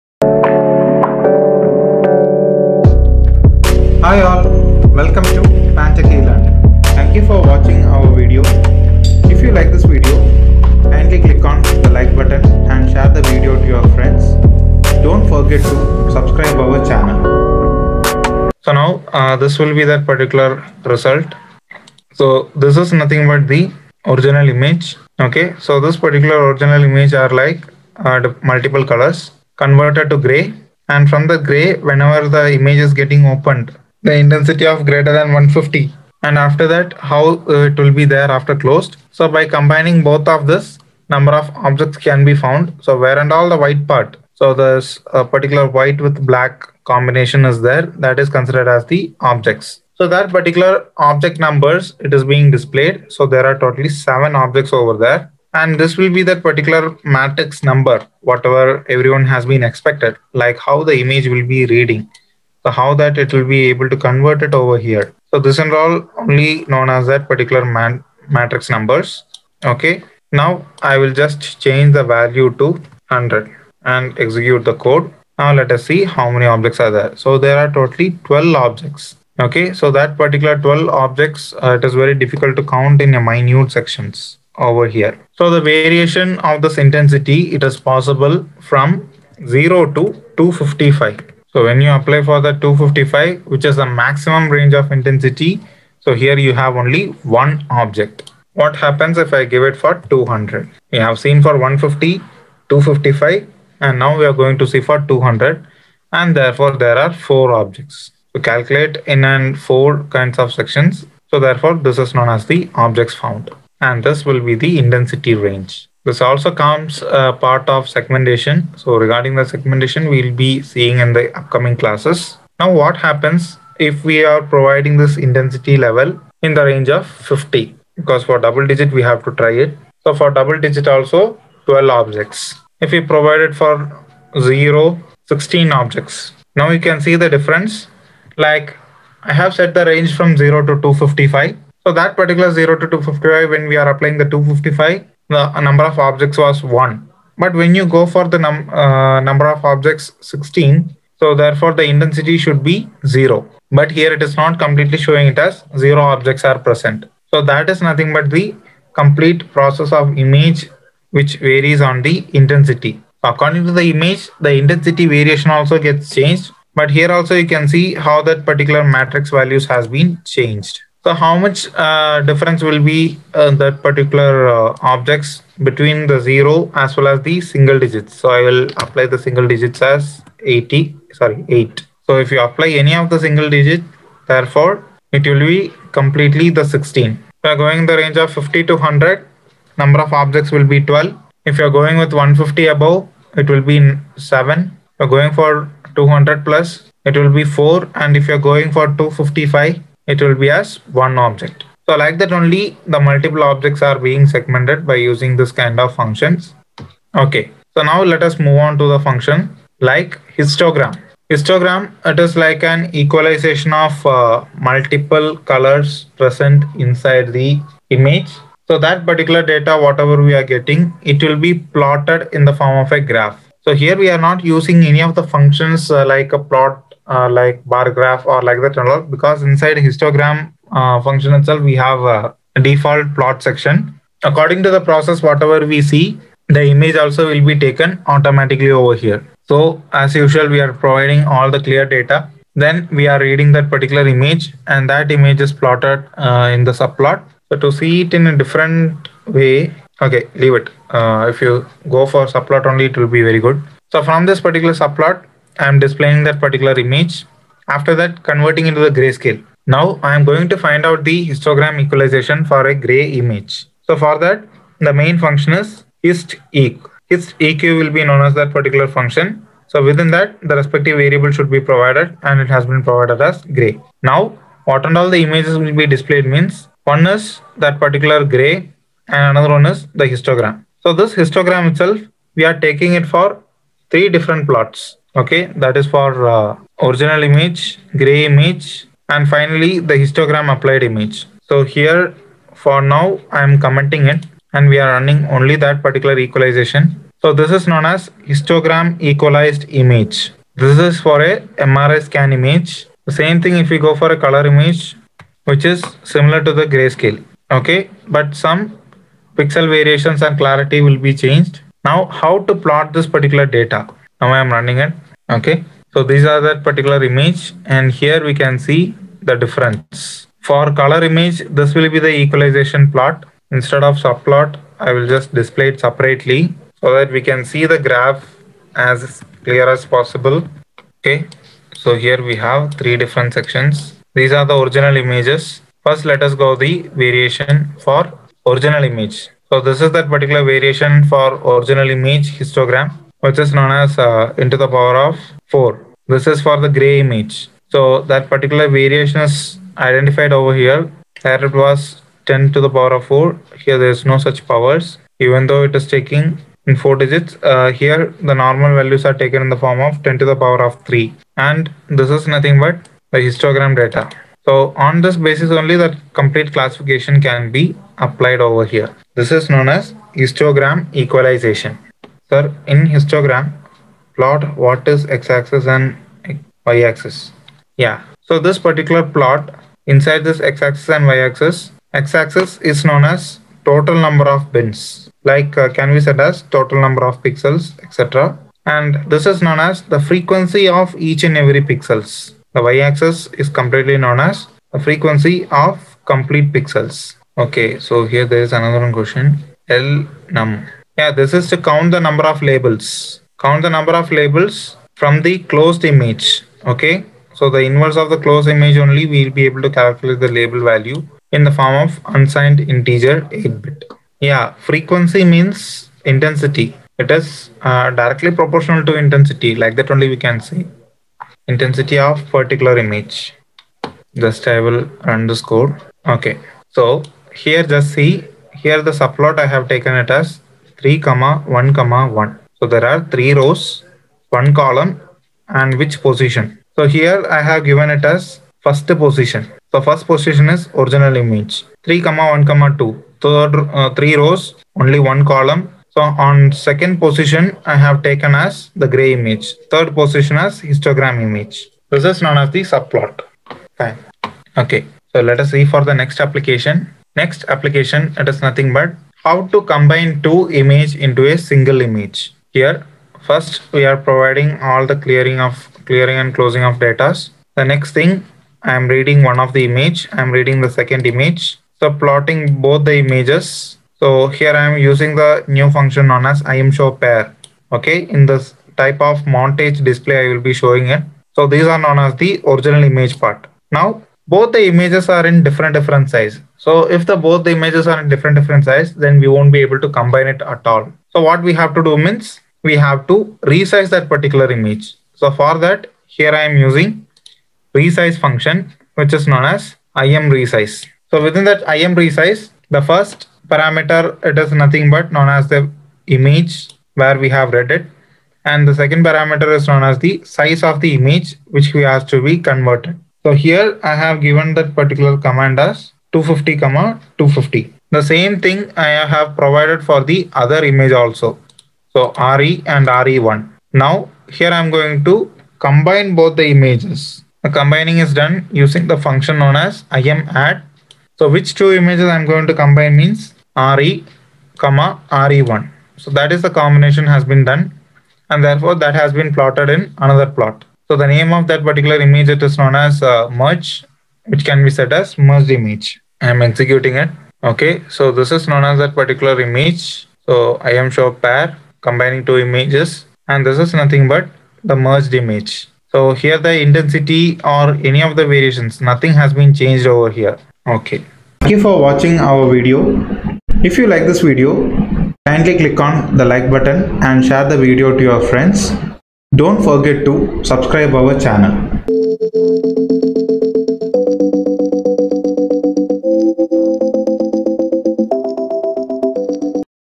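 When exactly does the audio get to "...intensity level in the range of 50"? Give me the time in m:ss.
2:05.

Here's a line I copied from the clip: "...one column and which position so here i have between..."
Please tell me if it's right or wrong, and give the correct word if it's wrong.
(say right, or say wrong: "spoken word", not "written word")
wrong: "given", not "between".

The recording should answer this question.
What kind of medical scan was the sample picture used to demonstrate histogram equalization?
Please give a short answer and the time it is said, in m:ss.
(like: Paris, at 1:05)
MRI scan, at 5:01.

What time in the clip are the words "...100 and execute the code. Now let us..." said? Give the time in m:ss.
1:12.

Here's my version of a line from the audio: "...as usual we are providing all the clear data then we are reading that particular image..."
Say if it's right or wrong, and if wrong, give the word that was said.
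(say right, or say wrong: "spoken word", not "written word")
right.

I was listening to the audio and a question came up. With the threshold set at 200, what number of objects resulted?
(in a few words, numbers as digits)
4.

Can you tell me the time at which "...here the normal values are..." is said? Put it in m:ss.
5:57.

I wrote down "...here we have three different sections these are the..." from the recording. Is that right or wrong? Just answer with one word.
right.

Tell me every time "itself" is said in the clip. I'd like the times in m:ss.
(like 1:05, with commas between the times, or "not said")
3:51, 4:41.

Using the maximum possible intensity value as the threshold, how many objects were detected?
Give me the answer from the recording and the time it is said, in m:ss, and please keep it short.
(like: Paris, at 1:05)
1, at 1:36.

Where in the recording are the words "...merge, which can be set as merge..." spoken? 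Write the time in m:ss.
9:03.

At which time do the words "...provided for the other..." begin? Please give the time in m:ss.
8:39.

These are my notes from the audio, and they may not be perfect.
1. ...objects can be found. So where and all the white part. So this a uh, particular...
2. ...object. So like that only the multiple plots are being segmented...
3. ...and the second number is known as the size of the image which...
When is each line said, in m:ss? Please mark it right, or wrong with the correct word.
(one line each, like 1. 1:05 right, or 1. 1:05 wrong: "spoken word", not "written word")
1. 0:41 right
2. 3:21 wrong: "objects", not "plots"
3. 8:28 wrong: "parameter", not "number".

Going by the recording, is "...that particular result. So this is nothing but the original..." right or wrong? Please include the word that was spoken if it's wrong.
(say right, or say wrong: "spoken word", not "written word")
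right.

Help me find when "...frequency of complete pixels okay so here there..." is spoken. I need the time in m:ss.
6:34.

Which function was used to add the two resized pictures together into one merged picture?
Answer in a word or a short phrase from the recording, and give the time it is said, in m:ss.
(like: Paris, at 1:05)
imadd, at 8:49.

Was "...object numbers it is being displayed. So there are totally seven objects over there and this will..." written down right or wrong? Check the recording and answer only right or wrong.
right.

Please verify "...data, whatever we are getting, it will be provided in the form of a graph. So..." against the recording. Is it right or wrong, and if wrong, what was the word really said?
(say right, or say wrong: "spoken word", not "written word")
wrong: "plotted", not "provided".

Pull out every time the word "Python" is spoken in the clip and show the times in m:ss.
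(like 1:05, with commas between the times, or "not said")
not said.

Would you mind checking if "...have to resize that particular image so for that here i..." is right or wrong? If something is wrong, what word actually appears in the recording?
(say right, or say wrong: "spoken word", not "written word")
right.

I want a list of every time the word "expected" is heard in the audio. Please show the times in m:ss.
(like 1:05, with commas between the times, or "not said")
0:59.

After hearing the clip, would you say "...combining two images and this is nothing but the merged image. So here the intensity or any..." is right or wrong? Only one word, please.
right.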